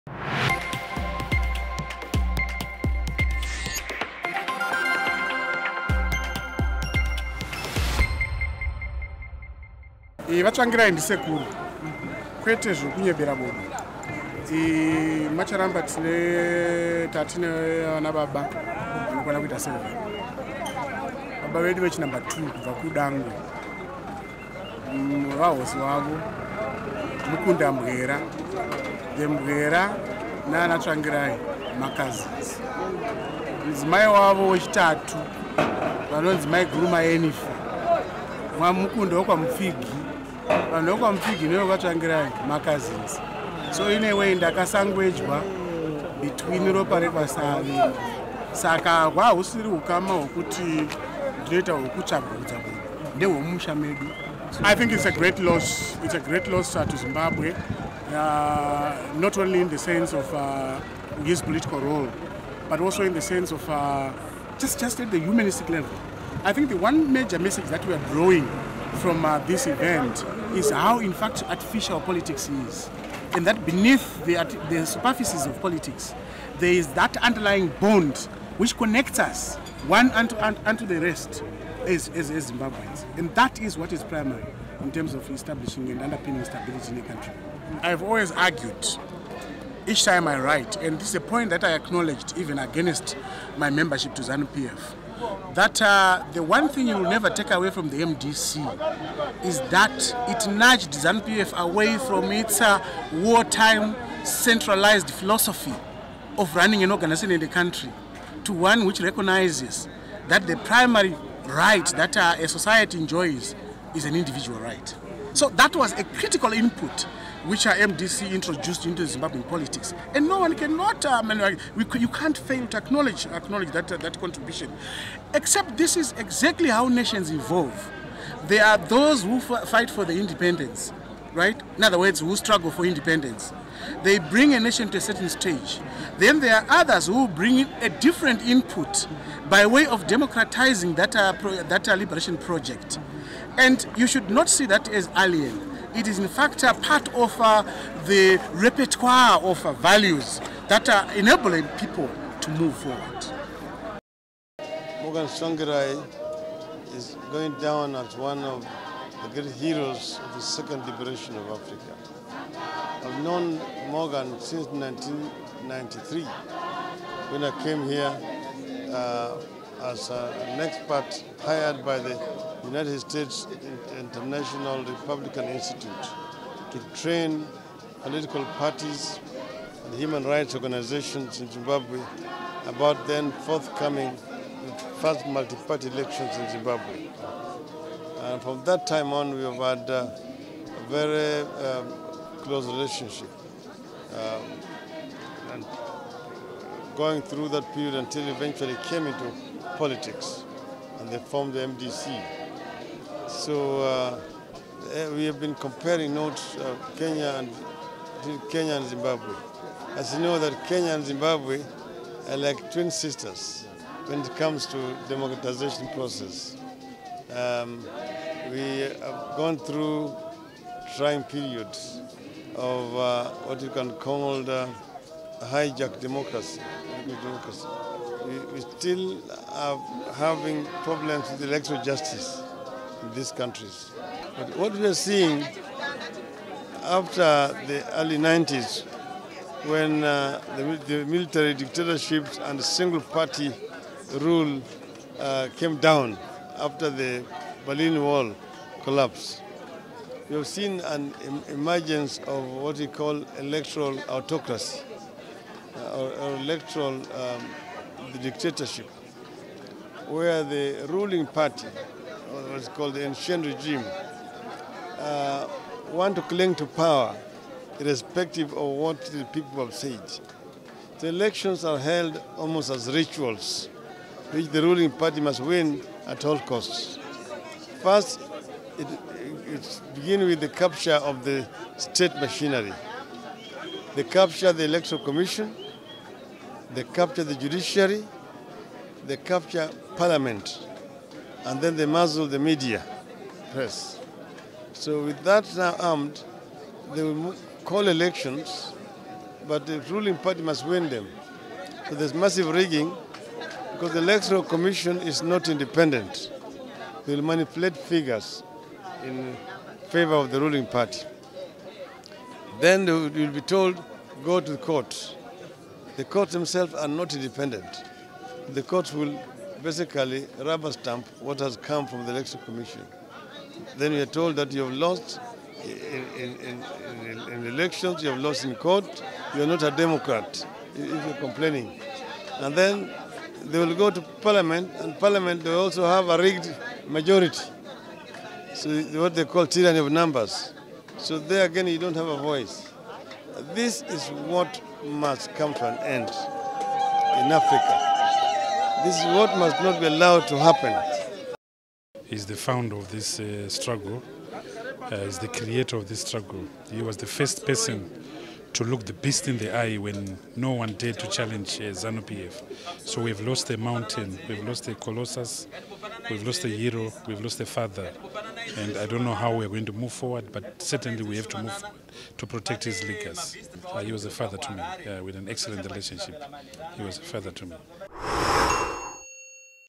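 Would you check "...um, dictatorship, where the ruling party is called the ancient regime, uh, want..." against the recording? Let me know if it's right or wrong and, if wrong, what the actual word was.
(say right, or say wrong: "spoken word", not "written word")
right.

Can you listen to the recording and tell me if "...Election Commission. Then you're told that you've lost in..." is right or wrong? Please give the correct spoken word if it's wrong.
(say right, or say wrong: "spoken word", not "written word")
right.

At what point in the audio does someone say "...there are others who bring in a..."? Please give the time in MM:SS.
02:16.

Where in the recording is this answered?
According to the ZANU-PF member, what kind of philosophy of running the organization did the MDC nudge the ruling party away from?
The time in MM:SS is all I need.
01:43.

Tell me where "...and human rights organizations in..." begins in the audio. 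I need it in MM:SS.
02:59.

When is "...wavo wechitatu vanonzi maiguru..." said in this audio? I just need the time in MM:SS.
00:34.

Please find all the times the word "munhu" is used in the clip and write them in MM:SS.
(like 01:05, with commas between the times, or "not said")
00:13, 00:52.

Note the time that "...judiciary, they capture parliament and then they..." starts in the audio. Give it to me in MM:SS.
04:47.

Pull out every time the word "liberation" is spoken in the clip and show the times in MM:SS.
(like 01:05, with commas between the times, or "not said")
02:21, 02:40.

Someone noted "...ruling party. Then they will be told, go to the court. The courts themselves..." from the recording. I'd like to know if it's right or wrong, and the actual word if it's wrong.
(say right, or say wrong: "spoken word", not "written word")
right.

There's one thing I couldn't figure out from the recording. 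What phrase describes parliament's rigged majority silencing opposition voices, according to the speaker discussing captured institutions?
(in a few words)
Tyranny of numbers.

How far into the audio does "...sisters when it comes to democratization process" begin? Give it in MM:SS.
03:32.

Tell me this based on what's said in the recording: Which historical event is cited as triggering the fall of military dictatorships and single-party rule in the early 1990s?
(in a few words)
Berlin Wall collapse.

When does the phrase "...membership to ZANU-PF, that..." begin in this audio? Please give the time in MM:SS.
01:33.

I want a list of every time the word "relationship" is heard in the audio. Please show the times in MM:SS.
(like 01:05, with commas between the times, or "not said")
03:12, 06:15.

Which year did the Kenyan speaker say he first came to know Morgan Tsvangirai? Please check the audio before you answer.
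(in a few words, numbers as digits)
1993.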